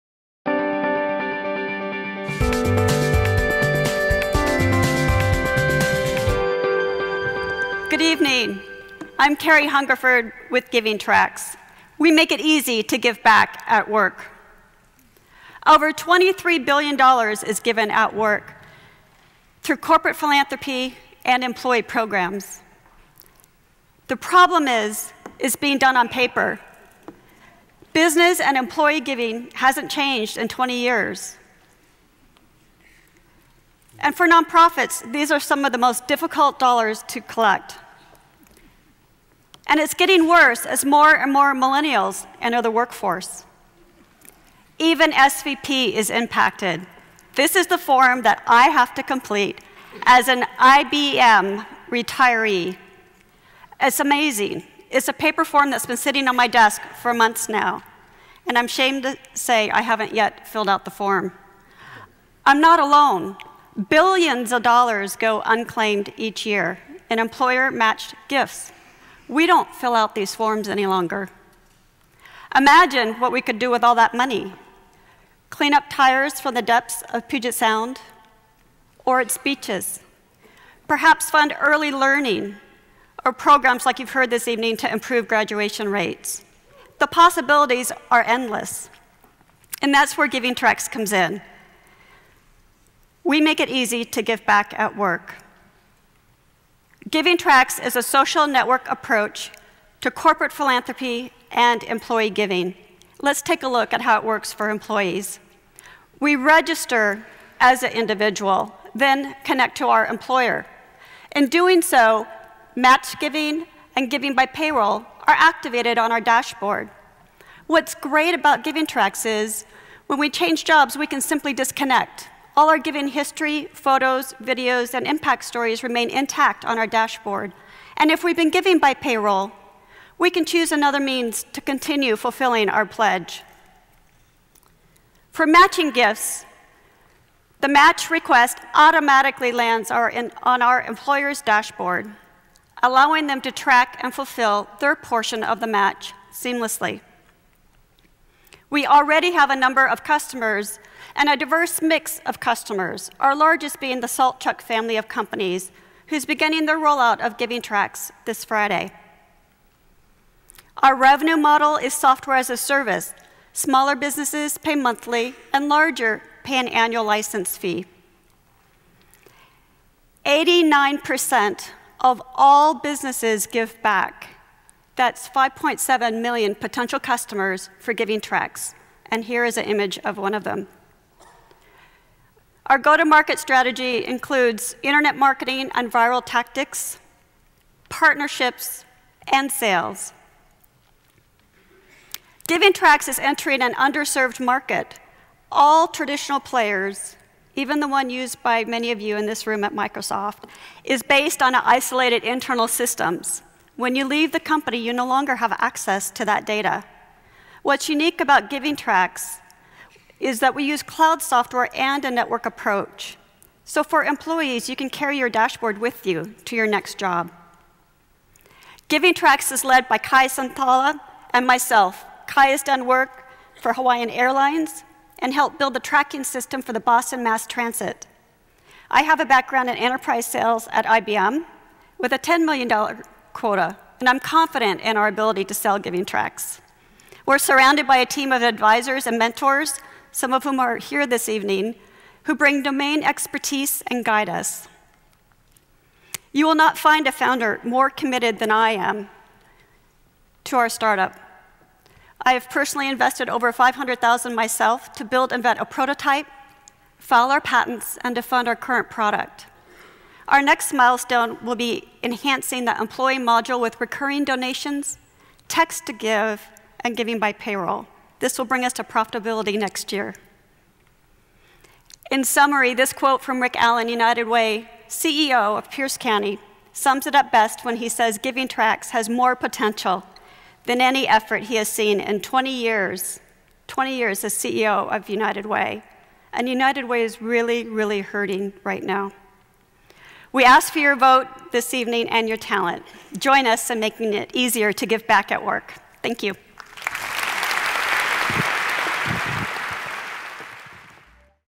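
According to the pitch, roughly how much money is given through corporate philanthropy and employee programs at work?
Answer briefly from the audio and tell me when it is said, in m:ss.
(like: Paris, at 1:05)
$23 billion, at 0:15.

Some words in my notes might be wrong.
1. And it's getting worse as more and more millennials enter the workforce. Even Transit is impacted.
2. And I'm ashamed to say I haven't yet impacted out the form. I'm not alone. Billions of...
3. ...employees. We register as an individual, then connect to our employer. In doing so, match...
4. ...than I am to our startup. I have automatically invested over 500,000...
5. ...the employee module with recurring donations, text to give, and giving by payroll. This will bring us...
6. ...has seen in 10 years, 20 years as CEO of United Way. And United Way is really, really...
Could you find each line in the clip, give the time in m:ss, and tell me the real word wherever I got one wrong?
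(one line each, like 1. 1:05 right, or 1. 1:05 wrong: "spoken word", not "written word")
1. 0:39 wrong: "SVP", not "Transit"
2. 0:58 wrong: "filled", not "impacted"
3. 1:44 right
4. 4:08 wrong: "personally", not "automatically"
5. 4:22 right
6. 4:41 wrong: "20", not "10".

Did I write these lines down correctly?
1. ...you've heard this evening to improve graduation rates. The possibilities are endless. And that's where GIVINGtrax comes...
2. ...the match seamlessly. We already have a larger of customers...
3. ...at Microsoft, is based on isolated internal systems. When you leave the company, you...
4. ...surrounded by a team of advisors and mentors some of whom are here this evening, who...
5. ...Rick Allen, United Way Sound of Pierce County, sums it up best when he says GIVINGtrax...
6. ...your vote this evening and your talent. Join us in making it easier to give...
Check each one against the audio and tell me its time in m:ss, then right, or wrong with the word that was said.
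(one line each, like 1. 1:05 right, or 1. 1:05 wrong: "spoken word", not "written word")
1. 1:23 right
2. 2:25 wrong: "number", not "larger"
3. 3:19 right
4. 3:57 right
5. 4:33 wrong: "CEO", not "Sound"
6. 4:50 right.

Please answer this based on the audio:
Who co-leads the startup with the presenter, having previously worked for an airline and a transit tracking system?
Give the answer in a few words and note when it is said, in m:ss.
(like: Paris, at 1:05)
Kai Santala, at 3:39.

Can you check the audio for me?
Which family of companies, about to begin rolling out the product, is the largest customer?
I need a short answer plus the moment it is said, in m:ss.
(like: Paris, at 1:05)
Saltchuk, at 2:34.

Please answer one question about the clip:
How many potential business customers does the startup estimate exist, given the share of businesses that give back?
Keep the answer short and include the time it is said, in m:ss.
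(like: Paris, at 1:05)
5.7 million, at 2:55.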